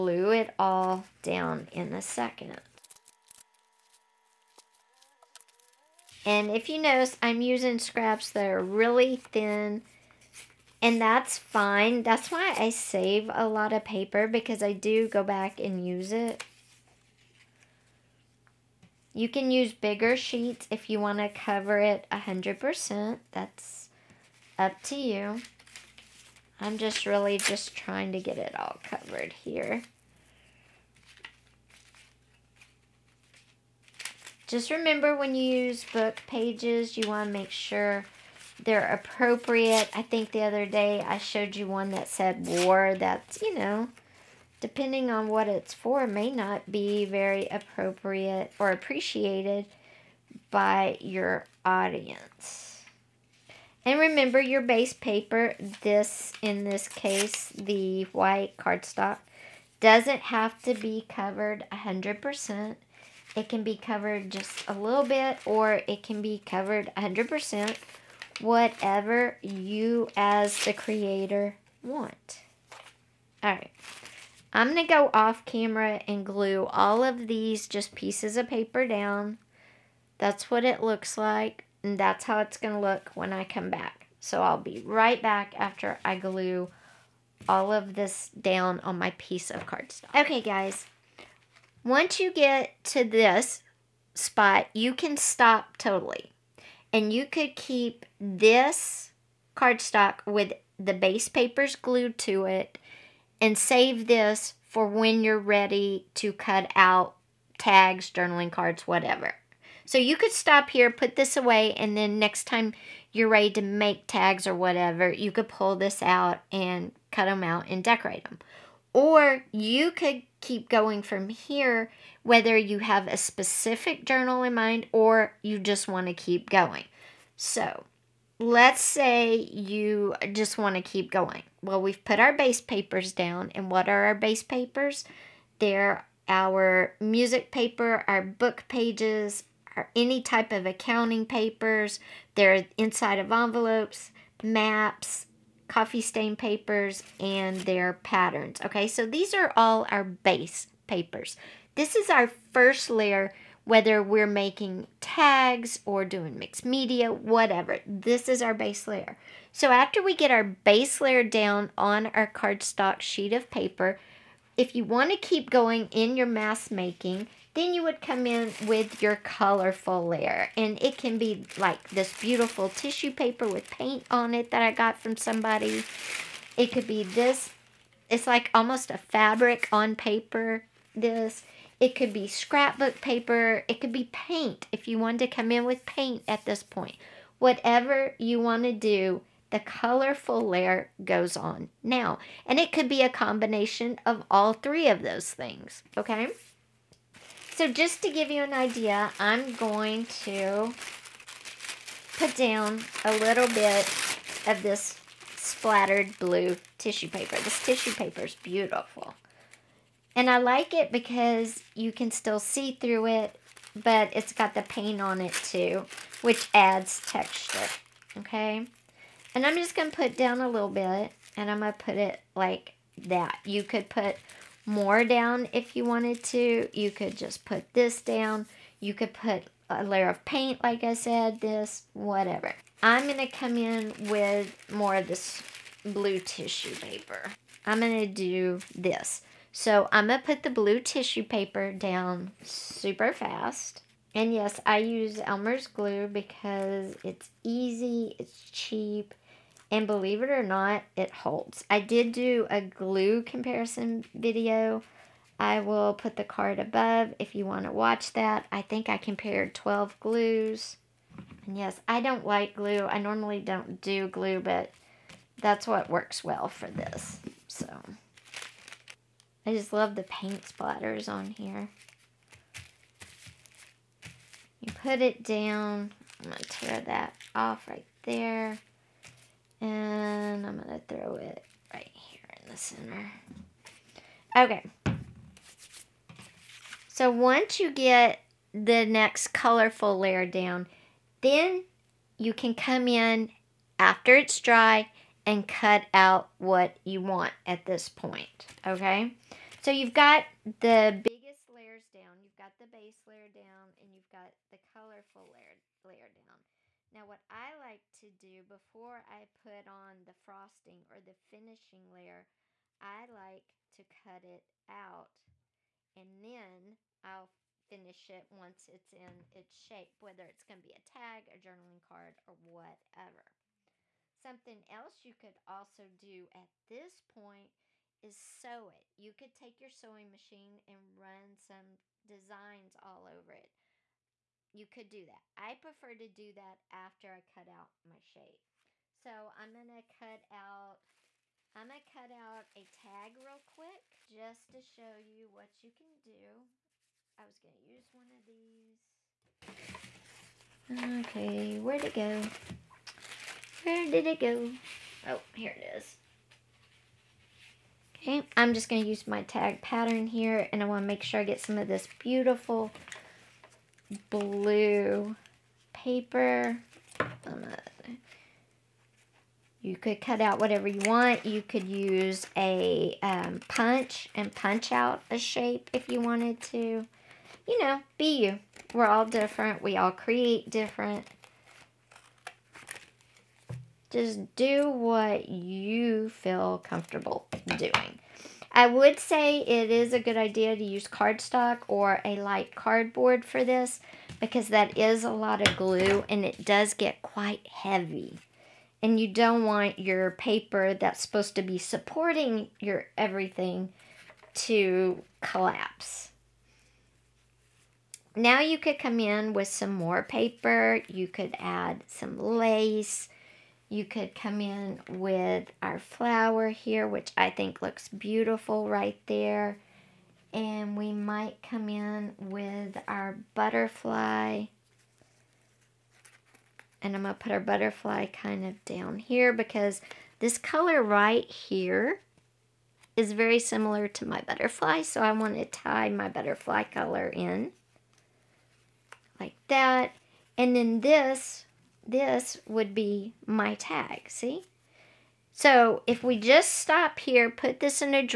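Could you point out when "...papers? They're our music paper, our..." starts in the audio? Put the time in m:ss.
2:14.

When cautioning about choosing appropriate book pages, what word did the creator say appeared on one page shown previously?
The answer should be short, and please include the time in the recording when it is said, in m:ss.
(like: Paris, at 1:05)
war, at 0:42.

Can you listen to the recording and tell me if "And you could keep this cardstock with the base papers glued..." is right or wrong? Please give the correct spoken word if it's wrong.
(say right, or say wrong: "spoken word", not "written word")
right.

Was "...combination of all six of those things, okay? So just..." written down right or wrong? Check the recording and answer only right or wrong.
wrong.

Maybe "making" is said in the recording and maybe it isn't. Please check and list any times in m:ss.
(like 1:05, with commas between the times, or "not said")
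2:34, 2:46.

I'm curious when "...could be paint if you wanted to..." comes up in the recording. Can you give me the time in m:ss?
3:03.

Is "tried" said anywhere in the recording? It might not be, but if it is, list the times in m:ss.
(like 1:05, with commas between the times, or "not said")
not said.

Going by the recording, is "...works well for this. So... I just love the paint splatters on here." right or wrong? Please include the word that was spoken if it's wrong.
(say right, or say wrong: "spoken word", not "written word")
right.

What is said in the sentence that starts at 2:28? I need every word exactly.
Okay, so these are all our base papers.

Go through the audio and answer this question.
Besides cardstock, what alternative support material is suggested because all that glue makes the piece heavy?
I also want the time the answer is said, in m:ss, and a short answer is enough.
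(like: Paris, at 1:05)
light cardboard, at 6:32.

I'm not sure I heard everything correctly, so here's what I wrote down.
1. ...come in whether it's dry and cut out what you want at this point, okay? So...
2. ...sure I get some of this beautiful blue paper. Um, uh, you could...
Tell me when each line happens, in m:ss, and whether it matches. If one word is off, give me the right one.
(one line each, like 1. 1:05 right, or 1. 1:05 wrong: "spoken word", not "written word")
1. 4:52 wrong: "after", not "whether"
2. 6:01 right.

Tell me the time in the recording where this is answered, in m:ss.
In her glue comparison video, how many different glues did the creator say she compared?
4:19.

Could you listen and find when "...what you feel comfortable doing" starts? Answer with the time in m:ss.
6:24.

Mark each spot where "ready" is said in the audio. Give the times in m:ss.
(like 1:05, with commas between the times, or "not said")
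1:45, 1:53.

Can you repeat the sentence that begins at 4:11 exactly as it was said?
I did do a glue comparison video.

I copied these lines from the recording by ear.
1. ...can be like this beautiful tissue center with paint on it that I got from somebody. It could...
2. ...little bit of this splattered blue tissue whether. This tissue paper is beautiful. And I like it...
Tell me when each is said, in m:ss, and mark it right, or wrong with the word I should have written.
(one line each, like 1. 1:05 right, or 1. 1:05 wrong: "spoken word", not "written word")
1. 2:50 wrong: "paper", not "center"
2. 3:23 wrong: "paper", not "whether".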